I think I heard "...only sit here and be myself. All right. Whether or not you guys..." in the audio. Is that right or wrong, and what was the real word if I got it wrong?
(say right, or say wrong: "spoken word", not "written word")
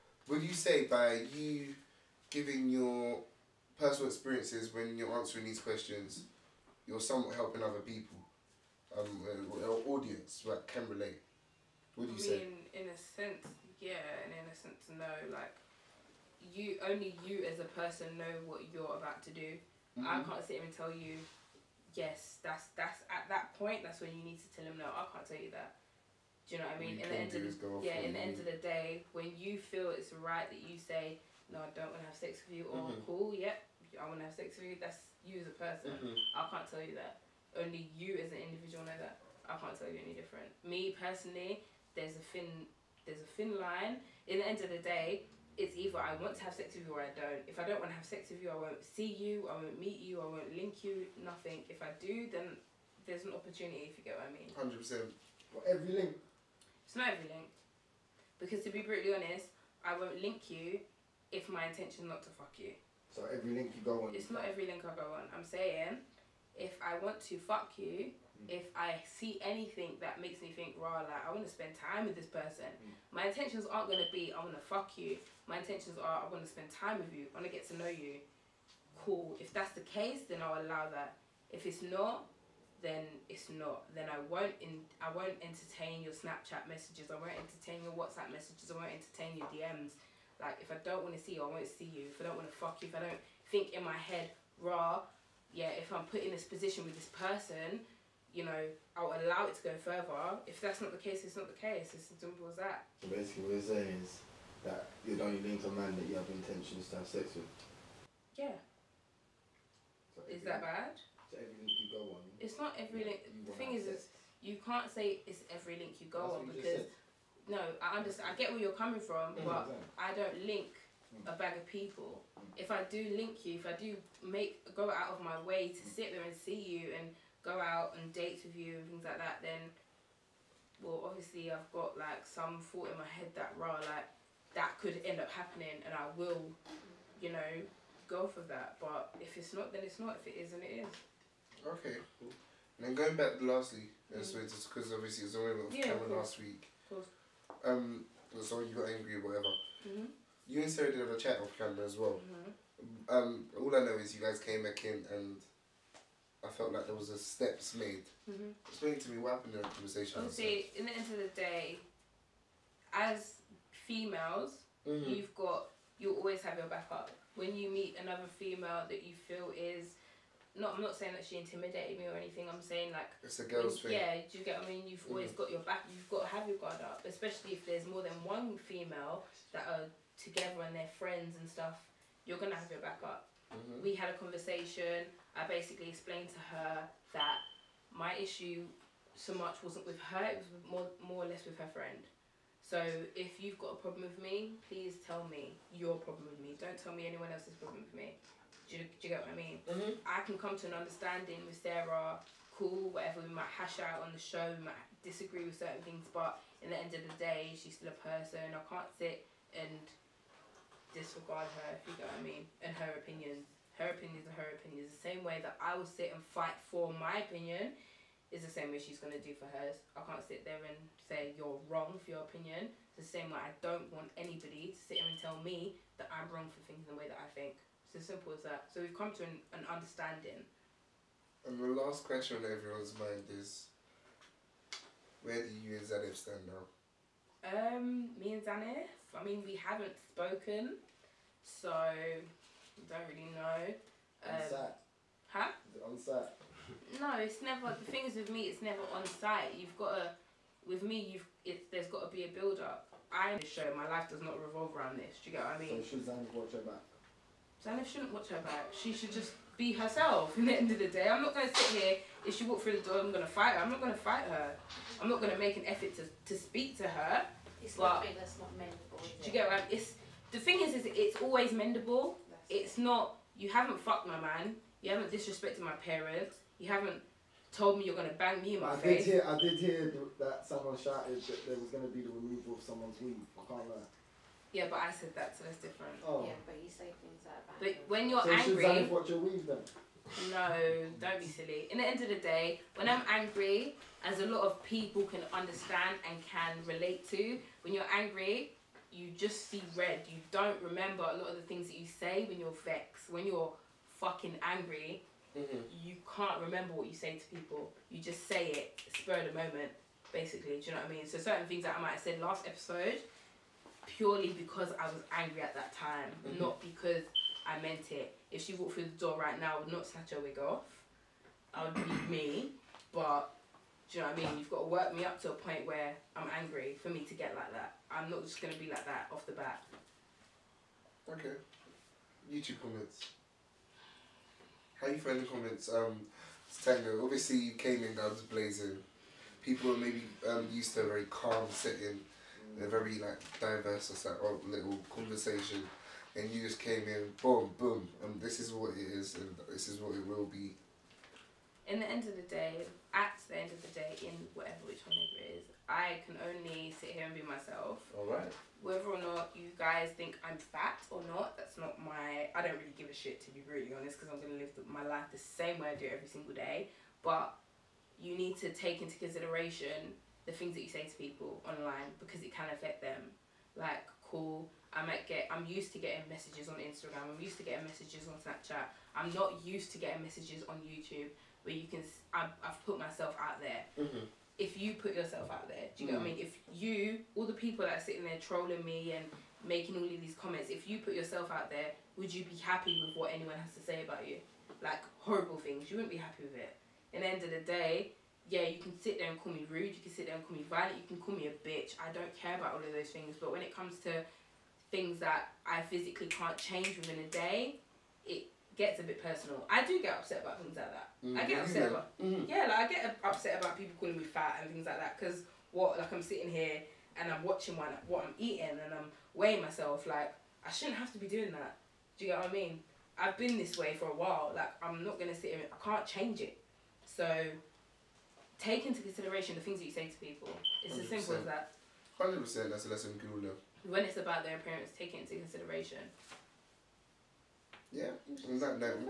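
right.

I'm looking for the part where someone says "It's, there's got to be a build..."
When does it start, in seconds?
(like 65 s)
251 s.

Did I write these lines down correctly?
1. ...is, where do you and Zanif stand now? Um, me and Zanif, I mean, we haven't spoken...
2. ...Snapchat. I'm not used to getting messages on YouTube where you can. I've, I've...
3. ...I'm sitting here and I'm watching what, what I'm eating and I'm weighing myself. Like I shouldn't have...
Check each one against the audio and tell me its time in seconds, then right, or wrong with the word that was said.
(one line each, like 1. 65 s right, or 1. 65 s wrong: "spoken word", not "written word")
1. 233 s right
2. 378 s right
3. 415 s right.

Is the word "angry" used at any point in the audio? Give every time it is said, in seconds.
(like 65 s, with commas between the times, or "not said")
148 s, 288 s, 293 s, 297 s, 304 s, 315 s, 326 s.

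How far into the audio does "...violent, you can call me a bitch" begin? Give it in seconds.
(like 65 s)
400 s.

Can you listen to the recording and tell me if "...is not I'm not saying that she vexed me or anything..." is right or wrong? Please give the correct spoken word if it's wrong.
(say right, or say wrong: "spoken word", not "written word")
wrong: "intimidated", not "vexed".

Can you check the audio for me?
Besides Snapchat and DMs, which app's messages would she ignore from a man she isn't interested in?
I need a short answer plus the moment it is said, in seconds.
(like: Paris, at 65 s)
WhatsApp, at 87 s.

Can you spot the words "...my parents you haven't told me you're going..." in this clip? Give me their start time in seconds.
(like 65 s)
275 s.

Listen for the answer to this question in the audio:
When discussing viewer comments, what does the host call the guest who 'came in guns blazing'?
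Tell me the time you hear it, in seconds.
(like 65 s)
336 s.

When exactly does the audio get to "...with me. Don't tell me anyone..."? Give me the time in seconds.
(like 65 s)
196 s.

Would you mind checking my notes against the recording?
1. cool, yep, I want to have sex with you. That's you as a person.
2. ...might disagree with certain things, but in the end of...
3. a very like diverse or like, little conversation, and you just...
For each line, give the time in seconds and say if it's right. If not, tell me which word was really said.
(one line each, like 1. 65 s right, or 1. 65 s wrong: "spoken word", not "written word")
1. 33 s right
2. 204 s right
3. 342 s right.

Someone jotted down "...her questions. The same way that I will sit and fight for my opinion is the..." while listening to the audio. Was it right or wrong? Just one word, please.
wrong.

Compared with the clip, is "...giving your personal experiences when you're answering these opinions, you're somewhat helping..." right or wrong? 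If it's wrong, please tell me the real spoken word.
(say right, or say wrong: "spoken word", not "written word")
wrong: "questions", not "opinions".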